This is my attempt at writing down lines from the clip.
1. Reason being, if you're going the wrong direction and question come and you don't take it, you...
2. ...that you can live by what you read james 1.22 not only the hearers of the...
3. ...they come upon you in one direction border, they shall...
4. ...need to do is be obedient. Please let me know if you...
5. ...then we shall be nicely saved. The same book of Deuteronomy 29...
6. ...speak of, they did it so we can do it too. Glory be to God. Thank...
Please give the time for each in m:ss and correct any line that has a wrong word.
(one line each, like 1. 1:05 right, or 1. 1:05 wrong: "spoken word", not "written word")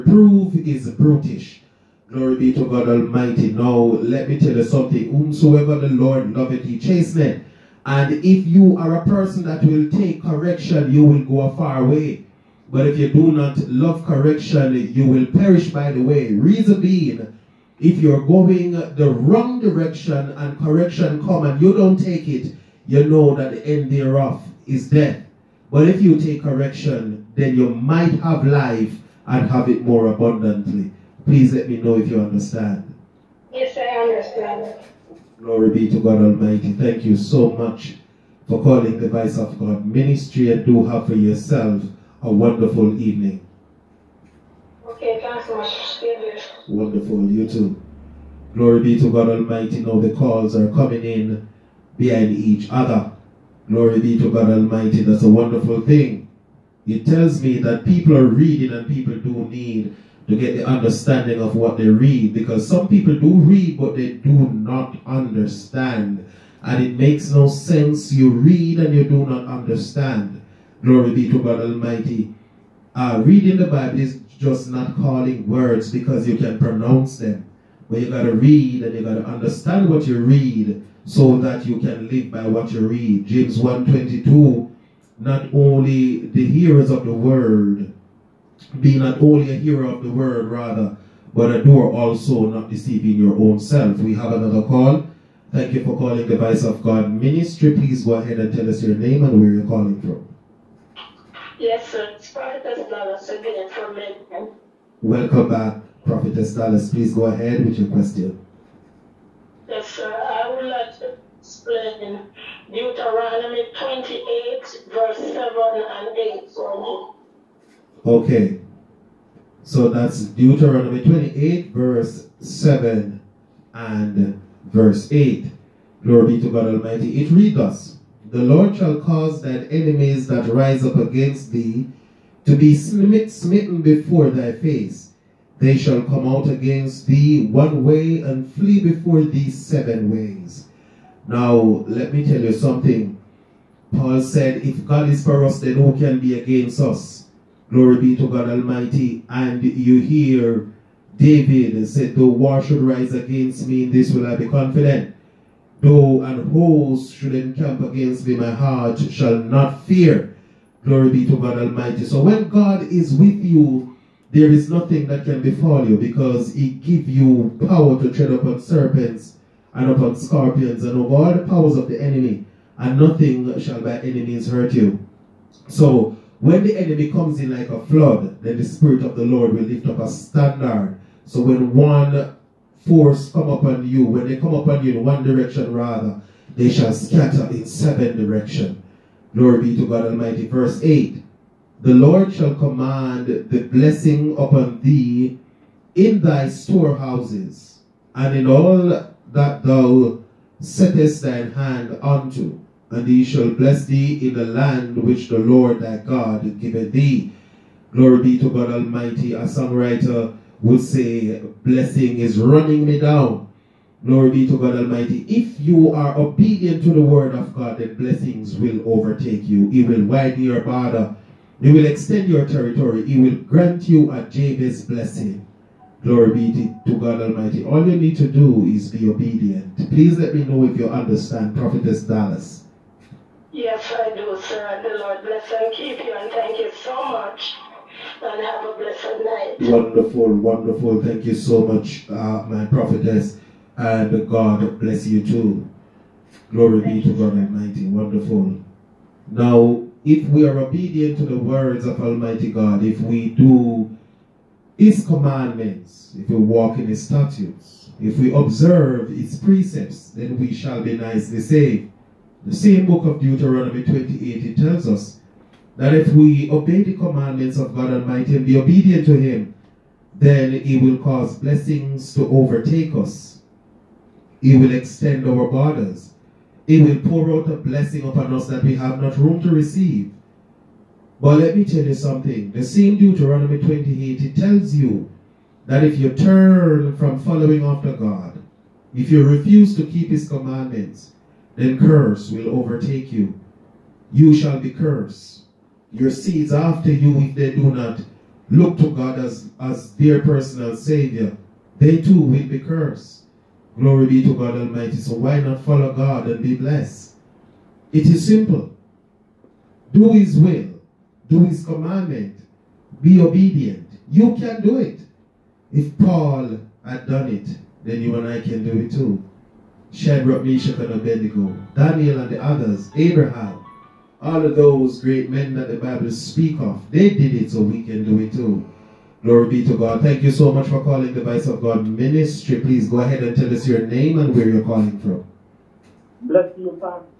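1. 0:16 wrong: "correction", not "question"
2. 1:21 right
3. 3:04 wrong: "rather", not "border"
4. 3:47 right
5. 4:20 wrong: "28", not "29"
6. 5:26 right.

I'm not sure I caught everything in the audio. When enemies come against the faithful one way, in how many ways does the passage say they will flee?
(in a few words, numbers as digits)
7.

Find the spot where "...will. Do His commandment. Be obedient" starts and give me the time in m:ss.
5:10.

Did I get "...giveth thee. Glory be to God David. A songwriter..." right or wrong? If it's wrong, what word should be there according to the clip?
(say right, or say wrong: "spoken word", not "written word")
wrong: "Almighty", not "David".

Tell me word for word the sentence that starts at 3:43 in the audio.
He will grant you a Jabez blessing.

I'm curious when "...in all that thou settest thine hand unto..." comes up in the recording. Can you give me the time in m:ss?
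3:18.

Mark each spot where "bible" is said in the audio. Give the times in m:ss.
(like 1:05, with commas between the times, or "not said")
1:13, 5:25.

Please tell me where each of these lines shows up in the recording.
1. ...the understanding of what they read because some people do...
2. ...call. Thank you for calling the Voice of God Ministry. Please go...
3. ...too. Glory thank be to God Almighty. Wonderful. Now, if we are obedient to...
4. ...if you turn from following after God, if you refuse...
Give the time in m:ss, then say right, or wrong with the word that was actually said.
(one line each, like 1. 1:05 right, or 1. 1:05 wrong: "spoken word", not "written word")
1. 1:00 right
2. 1:34 right
3. 4:05 right
4. 4:45 right.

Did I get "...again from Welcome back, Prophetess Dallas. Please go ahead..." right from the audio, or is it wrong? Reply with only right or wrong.
right.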